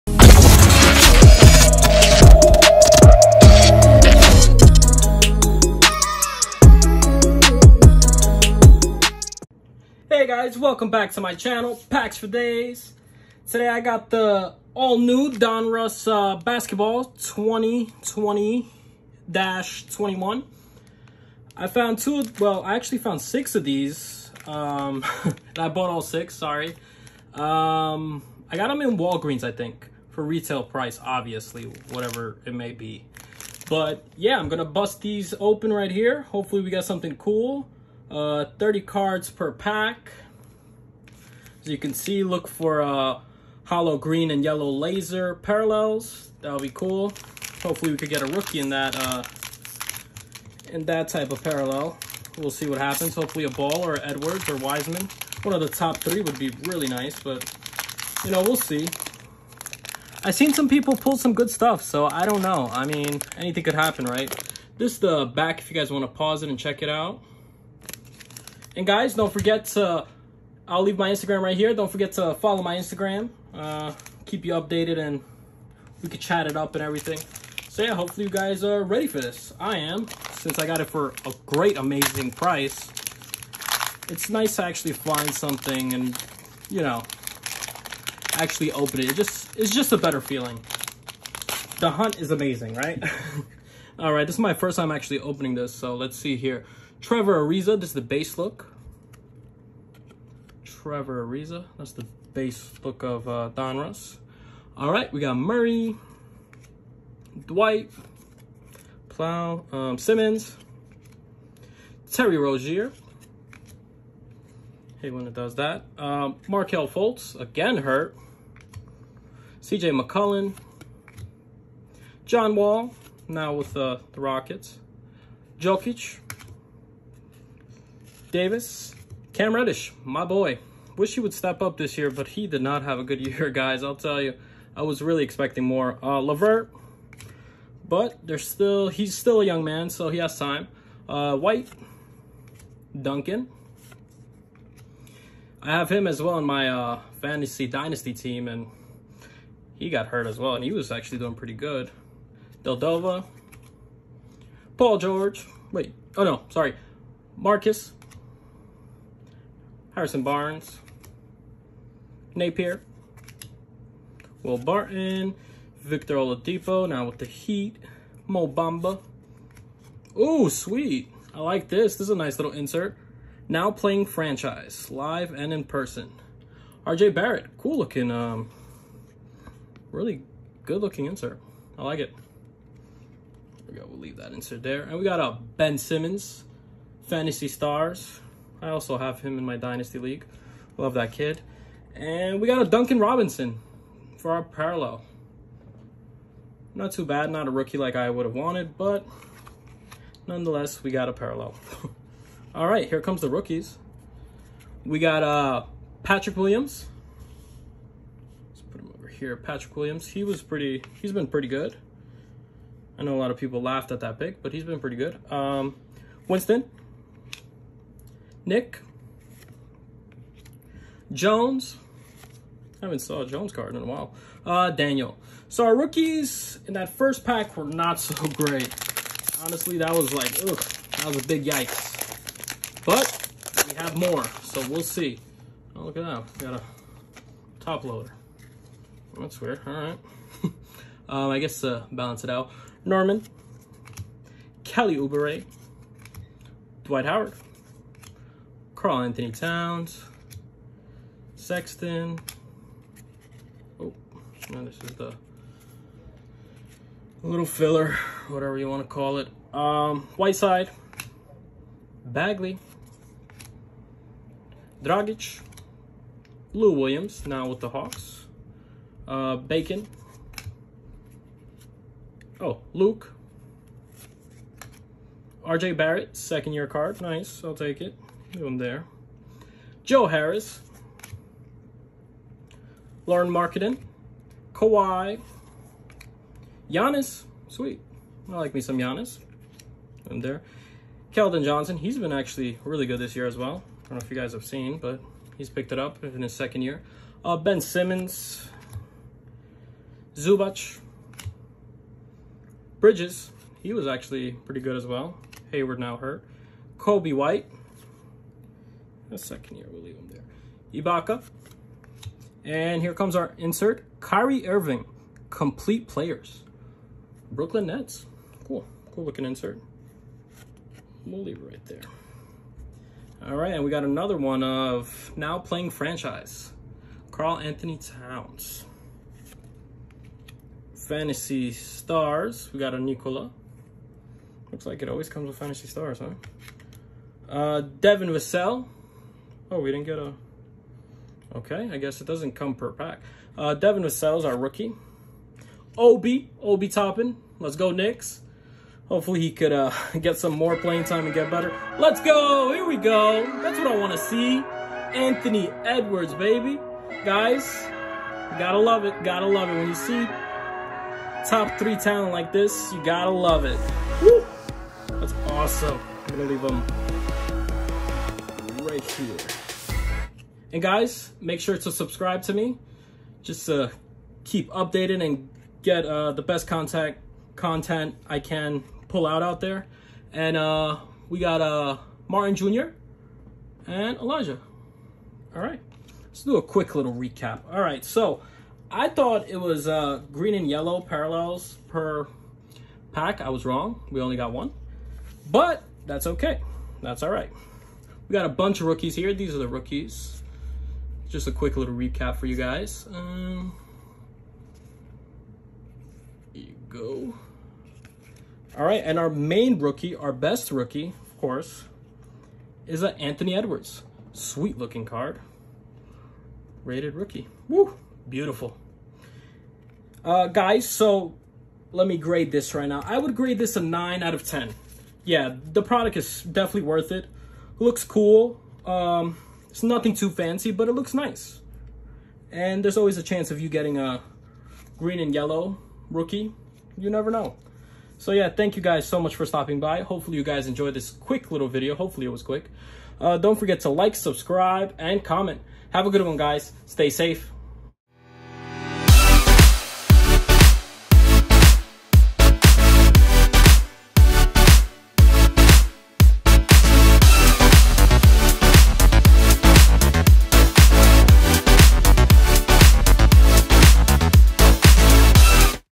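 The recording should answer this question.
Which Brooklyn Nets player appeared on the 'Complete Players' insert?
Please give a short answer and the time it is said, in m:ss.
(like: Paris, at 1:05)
Kyrie Irving, at 5:13.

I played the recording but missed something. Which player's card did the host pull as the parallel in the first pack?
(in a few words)
Duncan Robinson.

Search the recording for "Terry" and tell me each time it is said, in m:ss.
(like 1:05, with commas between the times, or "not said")
1:52.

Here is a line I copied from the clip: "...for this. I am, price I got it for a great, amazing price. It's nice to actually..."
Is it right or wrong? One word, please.
wrong.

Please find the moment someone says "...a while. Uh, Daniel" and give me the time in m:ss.
3:43.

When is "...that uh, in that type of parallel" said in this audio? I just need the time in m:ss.
0:48.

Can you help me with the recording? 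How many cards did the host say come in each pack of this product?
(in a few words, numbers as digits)
30.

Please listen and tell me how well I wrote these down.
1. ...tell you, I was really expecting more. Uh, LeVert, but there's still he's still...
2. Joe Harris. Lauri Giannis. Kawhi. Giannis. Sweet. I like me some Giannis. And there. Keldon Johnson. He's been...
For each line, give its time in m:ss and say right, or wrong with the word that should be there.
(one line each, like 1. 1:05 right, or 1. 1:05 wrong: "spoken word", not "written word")
1. 2:13 right
2. 4:39 wrong: "Markkanen", not "Giannis".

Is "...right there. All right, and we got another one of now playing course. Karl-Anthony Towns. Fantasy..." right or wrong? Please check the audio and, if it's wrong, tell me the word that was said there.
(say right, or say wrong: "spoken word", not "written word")
wrong: "franchise", not "course".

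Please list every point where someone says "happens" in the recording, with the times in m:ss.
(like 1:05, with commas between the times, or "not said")
0:52, 1:03.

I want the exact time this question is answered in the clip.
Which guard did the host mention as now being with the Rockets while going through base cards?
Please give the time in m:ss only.
2:02.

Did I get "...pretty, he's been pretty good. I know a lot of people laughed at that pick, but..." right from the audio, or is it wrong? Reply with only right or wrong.
right.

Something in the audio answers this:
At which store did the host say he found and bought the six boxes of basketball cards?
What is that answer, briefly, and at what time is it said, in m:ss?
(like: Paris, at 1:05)
Walgreens, at 0:28.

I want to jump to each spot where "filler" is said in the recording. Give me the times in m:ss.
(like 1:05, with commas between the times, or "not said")
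4:17.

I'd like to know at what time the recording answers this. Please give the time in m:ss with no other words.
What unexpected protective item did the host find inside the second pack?
3:57.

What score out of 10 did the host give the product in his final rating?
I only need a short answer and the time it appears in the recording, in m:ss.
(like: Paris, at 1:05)
9, at 7:03.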